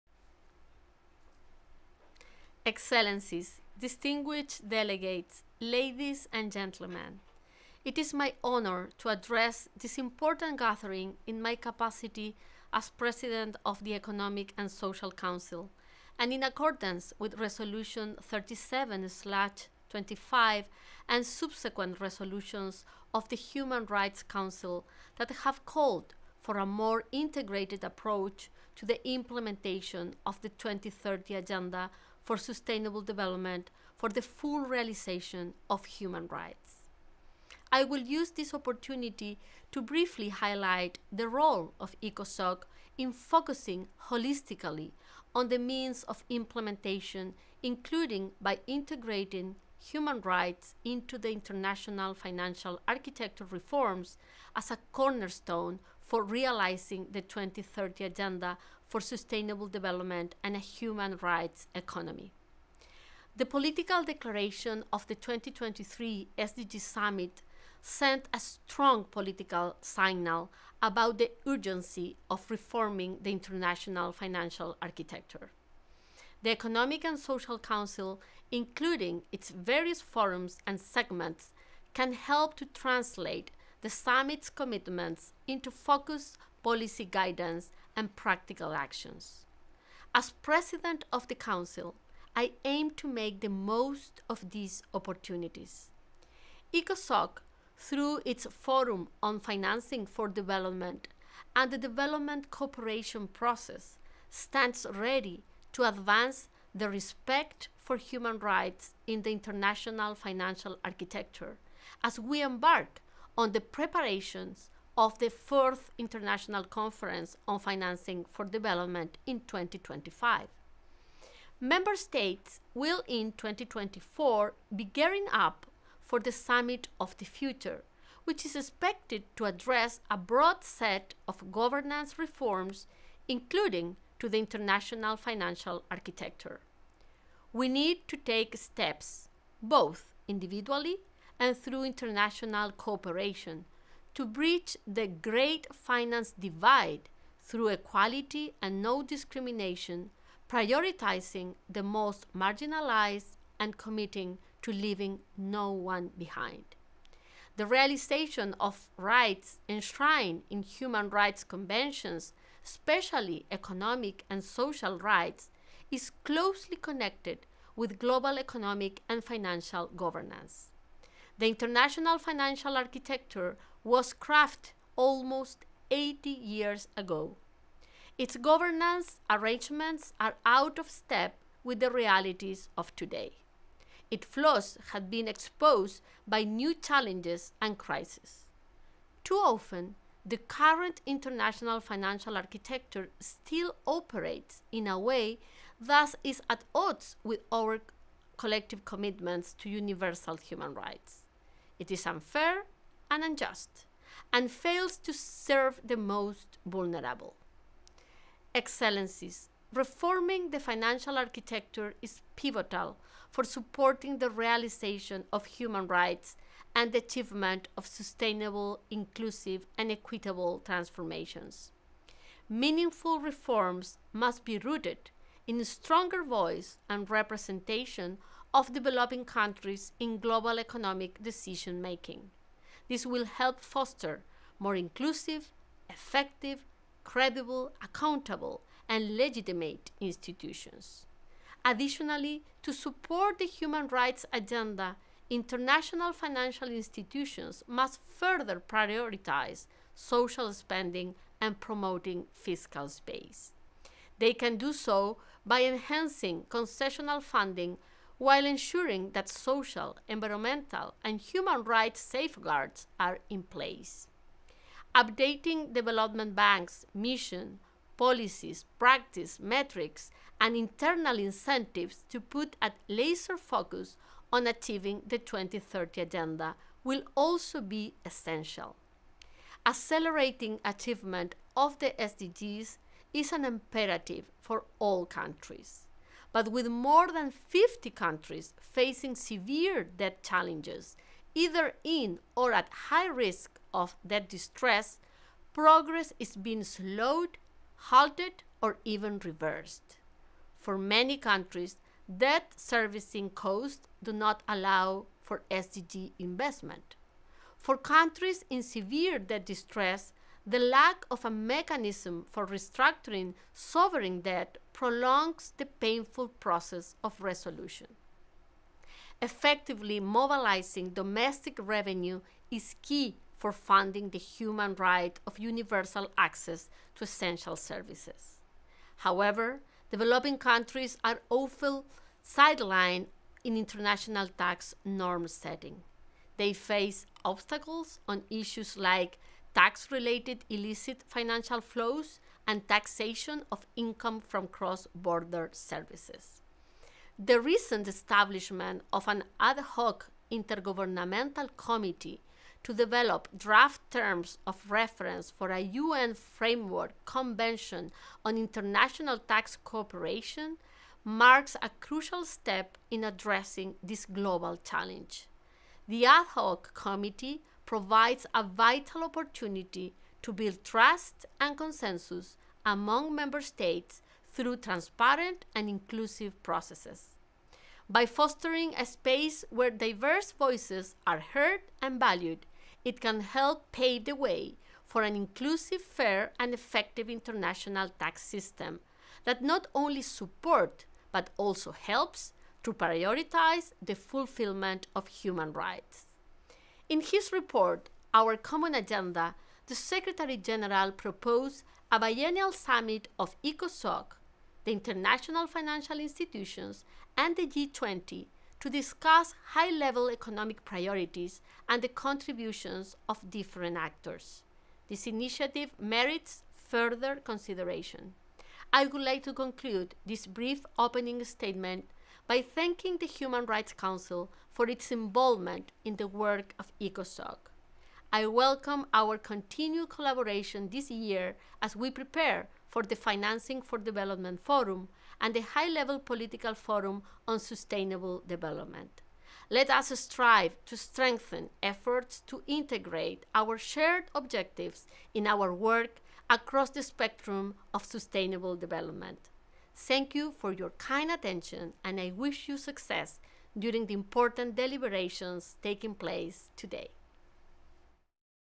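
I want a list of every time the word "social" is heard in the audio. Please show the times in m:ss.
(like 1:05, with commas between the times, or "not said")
0:14, 1:17, 2:44, 4:09, 4:19.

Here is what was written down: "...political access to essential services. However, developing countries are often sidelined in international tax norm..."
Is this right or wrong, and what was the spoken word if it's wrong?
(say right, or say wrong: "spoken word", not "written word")
wrong: "universal", not "political".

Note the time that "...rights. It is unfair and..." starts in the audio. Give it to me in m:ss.
3:20.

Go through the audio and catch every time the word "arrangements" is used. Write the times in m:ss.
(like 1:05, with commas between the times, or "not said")
2:59.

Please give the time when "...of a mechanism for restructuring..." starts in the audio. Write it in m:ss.
5:11.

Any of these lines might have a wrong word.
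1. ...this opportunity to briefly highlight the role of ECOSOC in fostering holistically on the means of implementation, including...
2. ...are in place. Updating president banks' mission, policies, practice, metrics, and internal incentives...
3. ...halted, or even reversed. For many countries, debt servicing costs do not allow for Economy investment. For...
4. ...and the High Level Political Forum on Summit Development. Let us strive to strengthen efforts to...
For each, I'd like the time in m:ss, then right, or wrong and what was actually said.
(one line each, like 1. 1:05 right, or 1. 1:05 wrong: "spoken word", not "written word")
1. 0:38 wrong: "focusing", not "fostering"
2. 4:22 wrong: "development", not "president"
3. 4:57 wrong: "SDG", not "Economy"
4. 7:15 wrong: "Sustainable", not "Summit".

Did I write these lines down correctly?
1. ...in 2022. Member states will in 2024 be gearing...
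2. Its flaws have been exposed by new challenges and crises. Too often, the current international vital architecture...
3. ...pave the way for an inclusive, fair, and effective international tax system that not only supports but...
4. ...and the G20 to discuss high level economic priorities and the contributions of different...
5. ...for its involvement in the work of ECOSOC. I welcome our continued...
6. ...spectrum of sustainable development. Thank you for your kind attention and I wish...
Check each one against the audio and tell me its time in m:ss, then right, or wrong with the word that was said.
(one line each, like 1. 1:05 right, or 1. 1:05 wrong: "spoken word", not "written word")
1. 1:59 wrong: "2025", not "2022"
2. 3:04 wrong: "financial", not "vital"
3. 6:23 right
4. 6:47 right
5. 7:04 right
6. 7:26 right.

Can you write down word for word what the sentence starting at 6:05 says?
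The ad hoc committee provides a vital opportunity to build trust and consensus among member states through transparent and inclusive processes.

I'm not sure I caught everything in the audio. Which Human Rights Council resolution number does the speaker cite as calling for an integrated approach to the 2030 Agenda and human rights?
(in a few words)
37/25.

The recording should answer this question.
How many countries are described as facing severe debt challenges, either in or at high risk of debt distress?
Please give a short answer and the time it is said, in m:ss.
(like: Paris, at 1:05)
More than 50, at 4:46.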